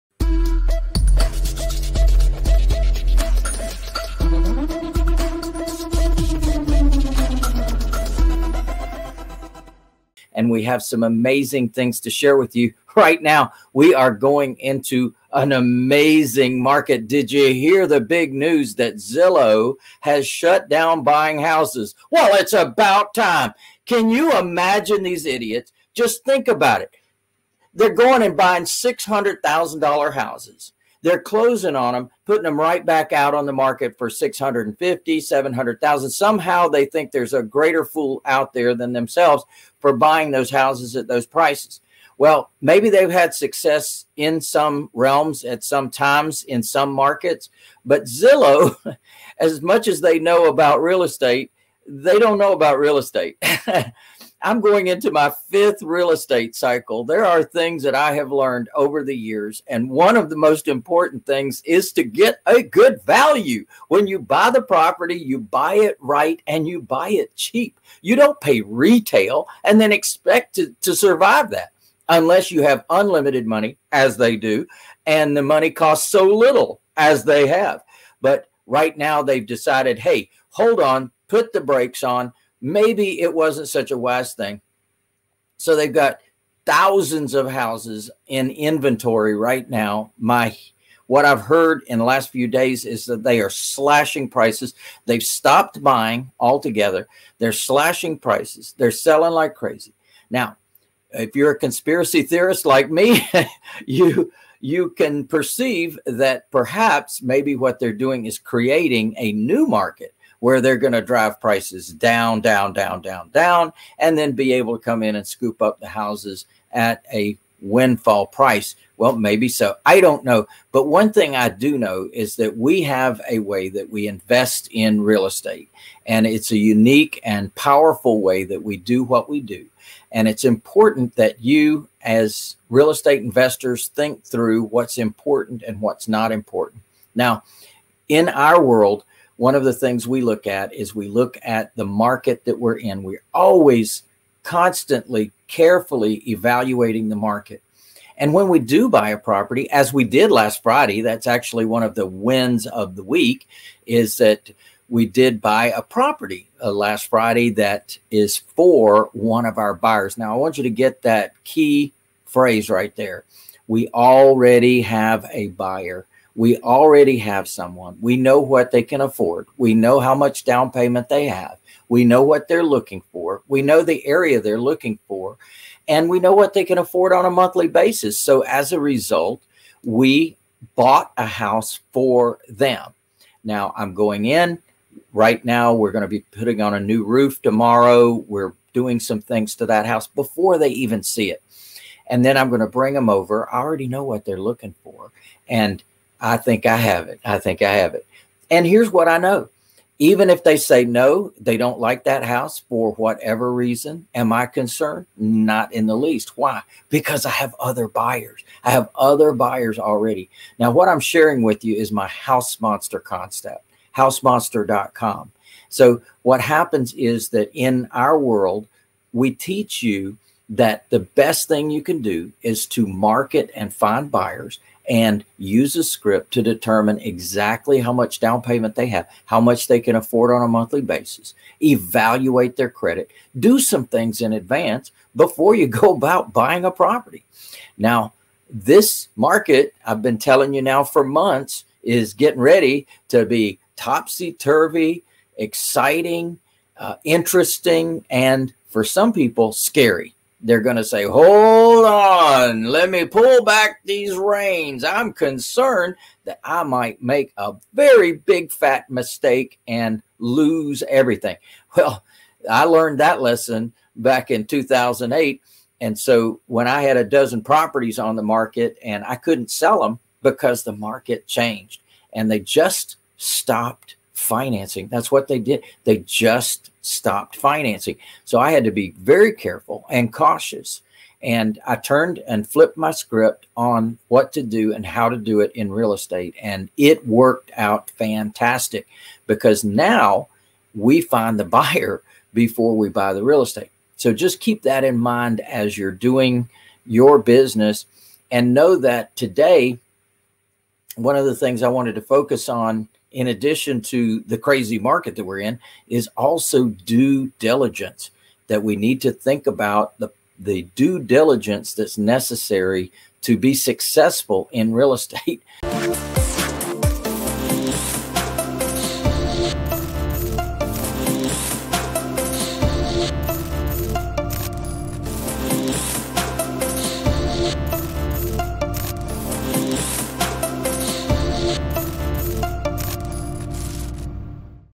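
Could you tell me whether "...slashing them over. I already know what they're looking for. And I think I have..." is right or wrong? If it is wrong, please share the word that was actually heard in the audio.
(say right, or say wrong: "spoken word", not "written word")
wrong: "bring", not "slashing".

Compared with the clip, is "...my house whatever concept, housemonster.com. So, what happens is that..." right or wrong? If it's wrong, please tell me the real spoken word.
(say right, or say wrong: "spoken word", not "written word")
wrong: "monster", not "whatever".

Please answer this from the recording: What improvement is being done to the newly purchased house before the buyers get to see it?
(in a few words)
new roof.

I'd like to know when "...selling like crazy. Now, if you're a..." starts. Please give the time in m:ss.
1:38.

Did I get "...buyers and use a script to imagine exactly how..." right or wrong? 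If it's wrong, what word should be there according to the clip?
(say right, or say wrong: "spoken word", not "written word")
wrong: "determine", not "imagine".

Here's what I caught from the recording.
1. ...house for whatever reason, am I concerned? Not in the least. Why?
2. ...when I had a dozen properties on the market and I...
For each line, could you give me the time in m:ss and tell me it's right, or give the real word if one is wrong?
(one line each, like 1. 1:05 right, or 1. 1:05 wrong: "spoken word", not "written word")
1. 3:22 right
2. 4:26 right.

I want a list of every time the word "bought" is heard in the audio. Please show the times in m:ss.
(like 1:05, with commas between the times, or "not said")
3:00.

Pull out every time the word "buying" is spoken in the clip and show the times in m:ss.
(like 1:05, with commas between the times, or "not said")
0:21, 0:28, 0:39, 1:35, 3:56.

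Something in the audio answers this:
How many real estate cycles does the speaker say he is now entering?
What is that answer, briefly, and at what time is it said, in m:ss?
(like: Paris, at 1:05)
fifth, at 0:55.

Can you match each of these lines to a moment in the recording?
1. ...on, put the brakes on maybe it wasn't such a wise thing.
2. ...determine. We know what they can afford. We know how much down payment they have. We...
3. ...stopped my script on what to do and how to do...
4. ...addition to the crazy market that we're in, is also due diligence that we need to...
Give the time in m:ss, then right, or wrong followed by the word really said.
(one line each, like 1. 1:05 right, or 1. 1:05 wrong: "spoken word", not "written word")
1. 1:20 right
2. 2:47 wrong: "someone", not "determine"
3. 4:42 wrong: "flipped", not "stopped"
4. 5:03 right.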